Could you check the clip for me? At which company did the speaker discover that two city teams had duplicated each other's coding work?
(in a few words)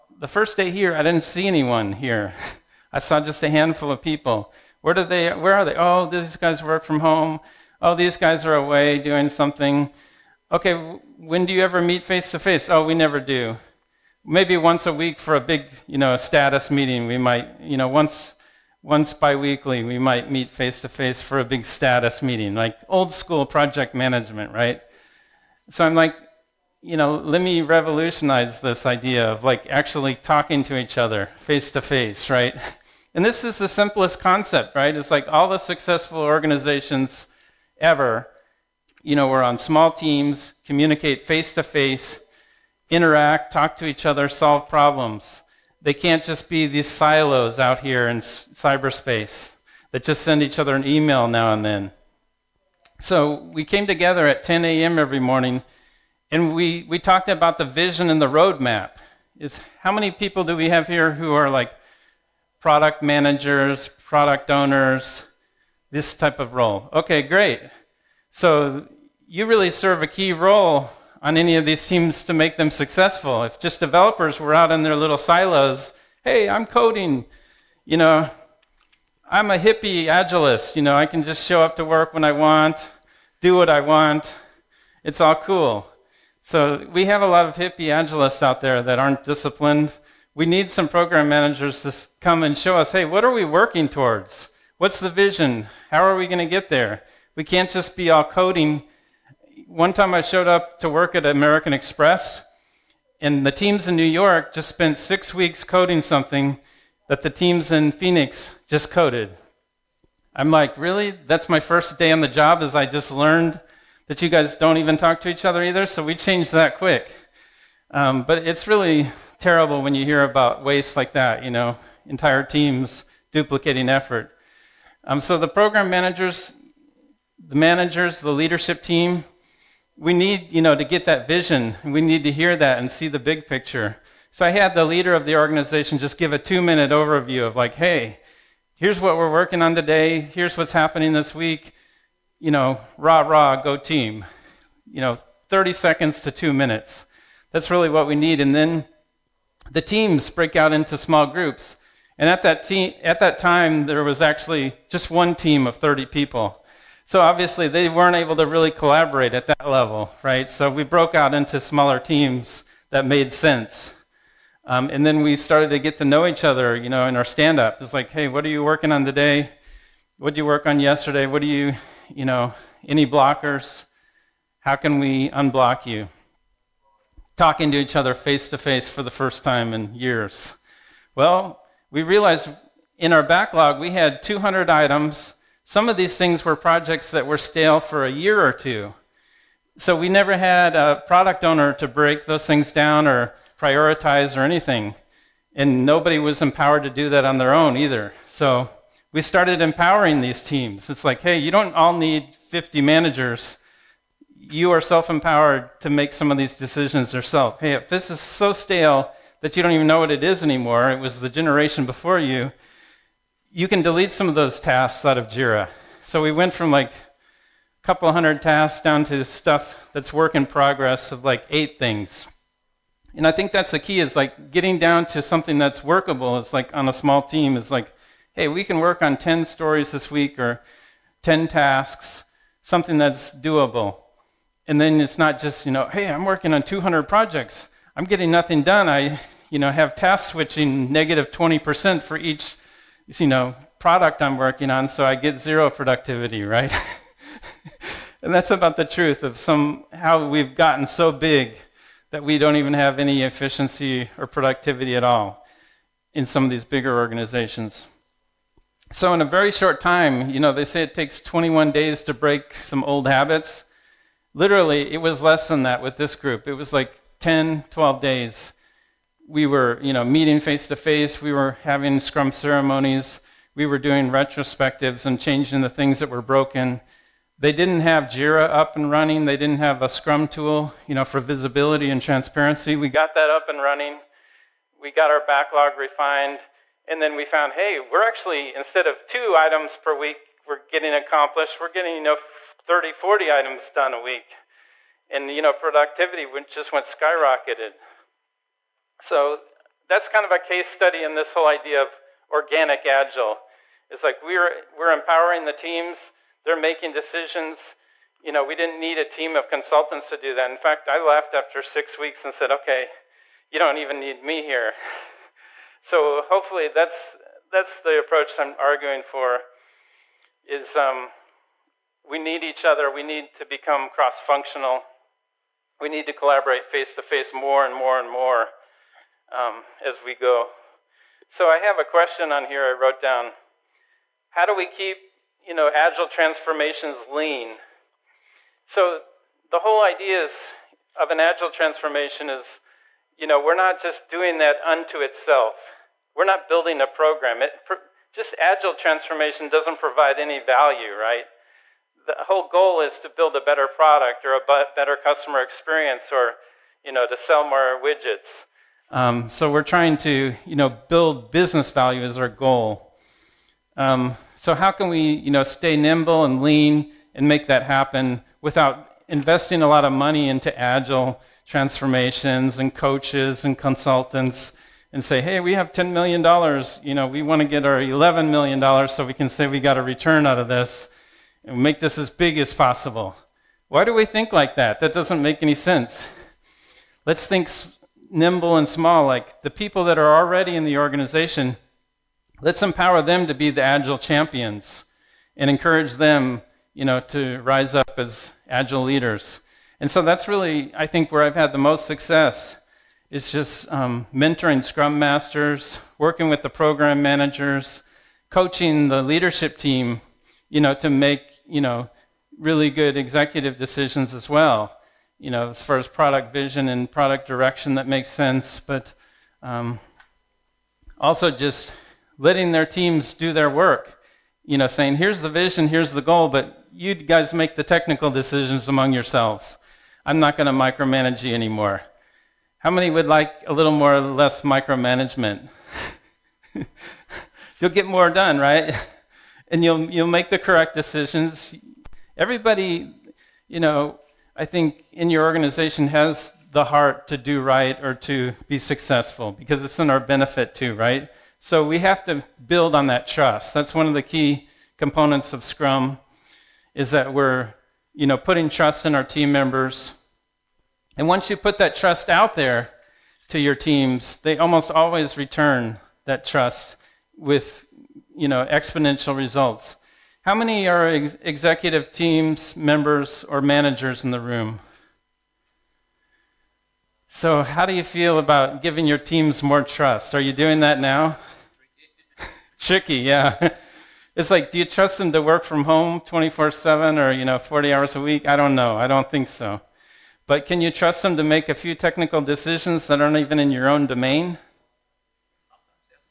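American Express.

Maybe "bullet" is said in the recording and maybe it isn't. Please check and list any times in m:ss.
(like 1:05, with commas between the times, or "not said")
not said.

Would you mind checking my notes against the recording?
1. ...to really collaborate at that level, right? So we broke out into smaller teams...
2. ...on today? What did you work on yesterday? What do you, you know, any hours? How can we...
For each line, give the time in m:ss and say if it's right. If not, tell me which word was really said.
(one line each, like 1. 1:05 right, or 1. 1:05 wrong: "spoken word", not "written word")
1. 2:38 right
2. 2:48 wrong: "blockers", not "hours".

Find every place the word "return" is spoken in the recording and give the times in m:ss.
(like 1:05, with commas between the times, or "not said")
6:19, 7:45.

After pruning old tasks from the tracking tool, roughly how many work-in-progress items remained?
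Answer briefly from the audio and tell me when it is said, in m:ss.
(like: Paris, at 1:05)
8, at 3:41.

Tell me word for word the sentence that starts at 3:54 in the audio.
And then it's not just, you know, hey, I'm working on 200 projects.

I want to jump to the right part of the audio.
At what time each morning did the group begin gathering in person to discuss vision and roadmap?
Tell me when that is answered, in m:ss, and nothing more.
0:54.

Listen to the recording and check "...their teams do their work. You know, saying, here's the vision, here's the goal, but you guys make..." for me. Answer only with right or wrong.
right.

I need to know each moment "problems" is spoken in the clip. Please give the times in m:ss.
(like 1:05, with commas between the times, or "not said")
0:44.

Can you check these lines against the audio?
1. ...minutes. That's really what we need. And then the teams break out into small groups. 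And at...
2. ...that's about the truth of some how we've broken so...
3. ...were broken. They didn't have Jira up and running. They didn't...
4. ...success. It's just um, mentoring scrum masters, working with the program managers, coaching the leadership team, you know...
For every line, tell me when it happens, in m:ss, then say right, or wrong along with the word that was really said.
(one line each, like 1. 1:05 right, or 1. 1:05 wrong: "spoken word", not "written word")
1. 2:26 right
2. 4:08 wrong: "gotten", not "broken"
3. 4:36 right
4. 6:41 right.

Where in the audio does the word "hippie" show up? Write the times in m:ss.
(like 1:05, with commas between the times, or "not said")
1:19, 1:27.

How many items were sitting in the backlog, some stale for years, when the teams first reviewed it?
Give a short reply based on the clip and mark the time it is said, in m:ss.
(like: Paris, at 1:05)
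200, at 3:04.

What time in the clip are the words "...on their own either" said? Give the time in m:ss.
3:17.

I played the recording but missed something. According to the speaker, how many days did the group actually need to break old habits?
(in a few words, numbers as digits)
10 to 12.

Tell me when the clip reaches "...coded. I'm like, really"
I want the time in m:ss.
1:48.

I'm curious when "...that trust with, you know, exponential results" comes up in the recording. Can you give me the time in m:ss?
7:46.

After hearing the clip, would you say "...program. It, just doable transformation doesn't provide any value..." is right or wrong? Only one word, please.
wrong.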